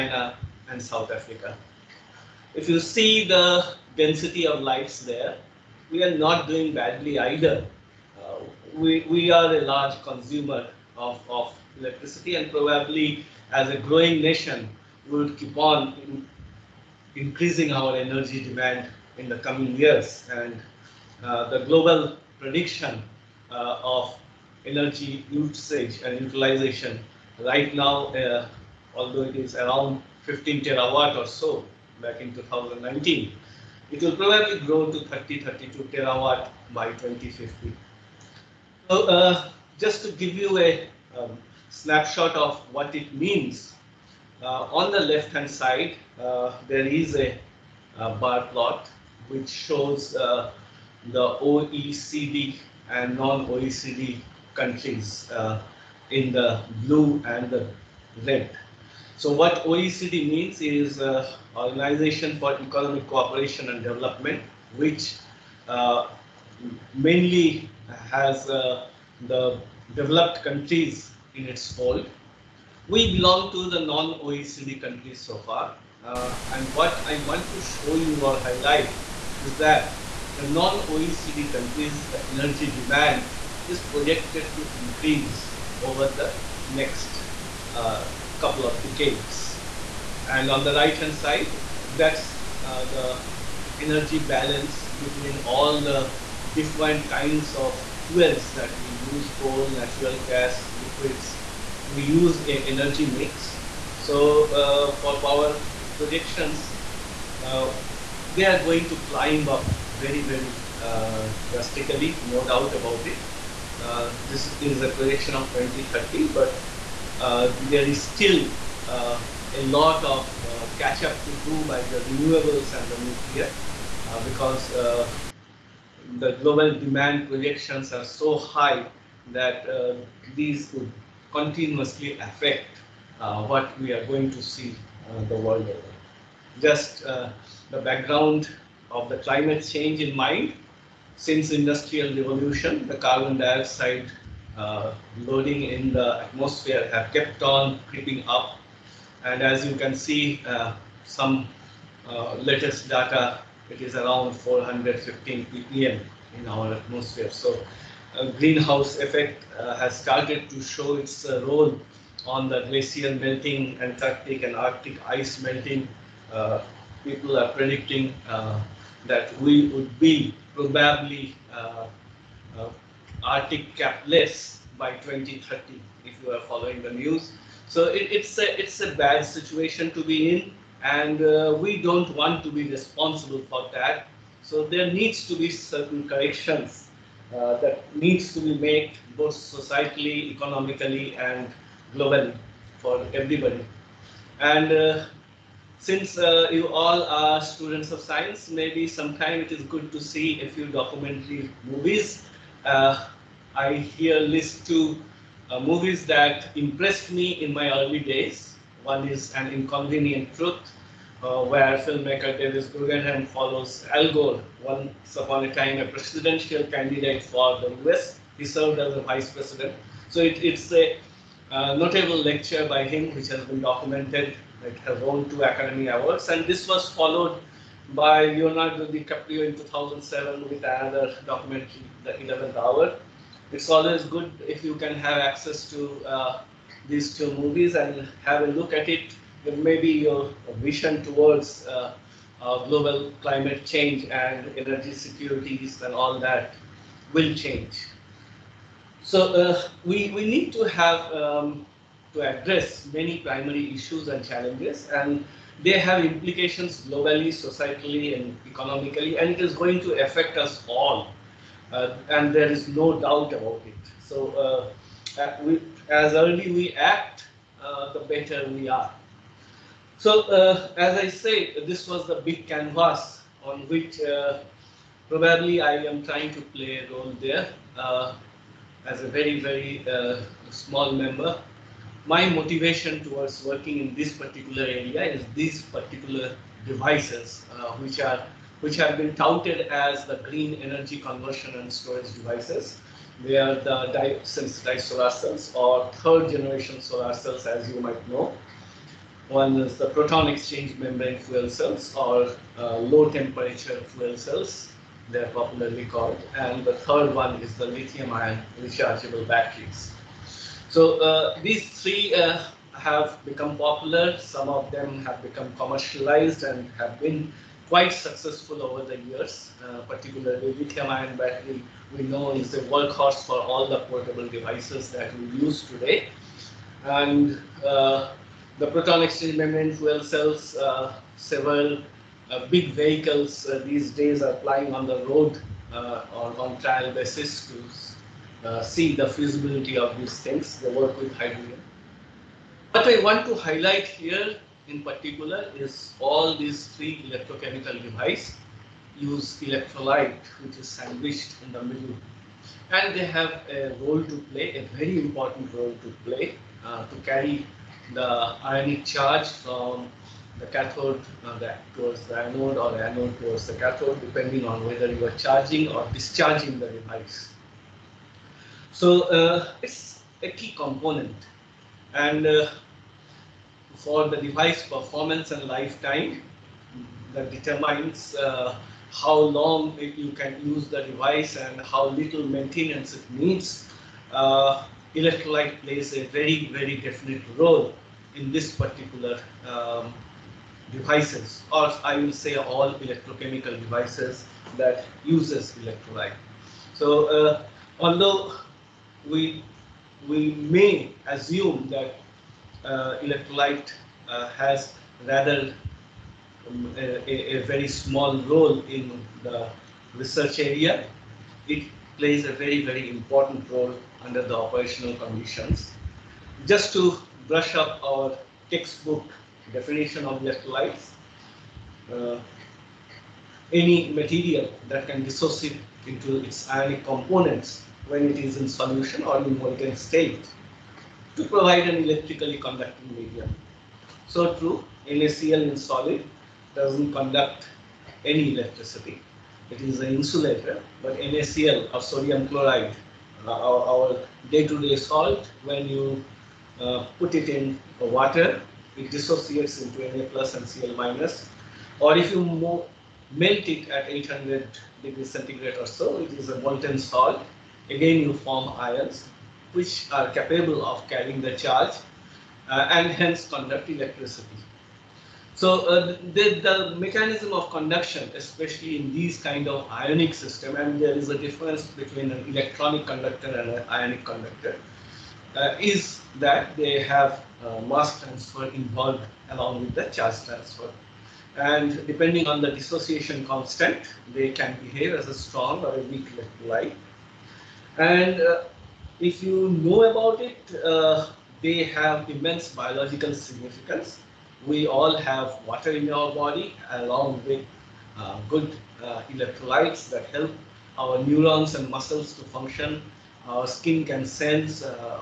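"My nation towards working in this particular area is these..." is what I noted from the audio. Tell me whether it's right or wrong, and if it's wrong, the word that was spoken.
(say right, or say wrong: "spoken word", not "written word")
wrong: "motivation", not "nation".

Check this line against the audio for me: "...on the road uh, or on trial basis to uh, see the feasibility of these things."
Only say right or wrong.
right.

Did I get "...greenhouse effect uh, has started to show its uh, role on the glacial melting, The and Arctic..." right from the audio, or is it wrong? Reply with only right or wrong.
wrong.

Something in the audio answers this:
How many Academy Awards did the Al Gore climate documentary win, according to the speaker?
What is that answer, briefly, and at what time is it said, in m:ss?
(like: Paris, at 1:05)
2, at 3:45.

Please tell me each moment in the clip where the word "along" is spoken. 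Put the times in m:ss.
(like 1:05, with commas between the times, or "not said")
7:59, 8:16.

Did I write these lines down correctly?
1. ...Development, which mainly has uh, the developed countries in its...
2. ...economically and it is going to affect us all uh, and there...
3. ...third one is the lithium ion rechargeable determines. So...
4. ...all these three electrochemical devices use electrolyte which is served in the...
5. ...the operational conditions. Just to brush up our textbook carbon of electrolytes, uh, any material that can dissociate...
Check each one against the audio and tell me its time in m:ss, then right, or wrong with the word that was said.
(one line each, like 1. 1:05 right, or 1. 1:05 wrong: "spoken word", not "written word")
1. 1:03 right
2. 4:18 right
3. 5:06 wrong: "batteries", not "determines"
4. 5:45 wrong: "sandwiched", not "served"
5. 6:54 wrong: "definition", not "carbon".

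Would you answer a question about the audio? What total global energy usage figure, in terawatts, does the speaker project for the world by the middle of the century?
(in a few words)
30 to 32 terawatts.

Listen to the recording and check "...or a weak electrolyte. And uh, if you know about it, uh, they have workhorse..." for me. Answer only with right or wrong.
wrong.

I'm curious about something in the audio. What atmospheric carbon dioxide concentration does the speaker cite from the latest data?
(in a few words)
415 ppm.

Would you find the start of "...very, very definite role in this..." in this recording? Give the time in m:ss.
6:26.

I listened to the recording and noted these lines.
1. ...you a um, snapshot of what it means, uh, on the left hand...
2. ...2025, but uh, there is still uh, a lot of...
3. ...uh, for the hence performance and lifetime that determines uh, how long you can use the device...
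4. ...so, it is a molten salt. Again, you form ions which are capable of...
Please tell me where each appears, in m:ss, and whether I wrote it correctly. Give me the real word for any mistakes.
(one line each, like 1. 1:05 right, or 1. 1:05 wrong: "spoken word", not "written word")
1. 0:40 right
2. 1:55 wrong: "2030", not "2025"
3. 6:12 wrong: "device", not "hence"
4. 7:35 right.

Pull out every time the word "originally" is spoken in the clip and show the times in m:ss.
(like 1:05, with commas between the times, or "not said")
not said.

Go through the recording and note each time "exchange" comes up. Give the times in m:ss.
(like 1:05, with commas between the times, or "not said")
5:00, 5:29.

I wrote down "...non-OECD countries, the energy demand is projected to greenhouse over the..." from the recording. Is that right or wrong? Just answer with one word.
wrong.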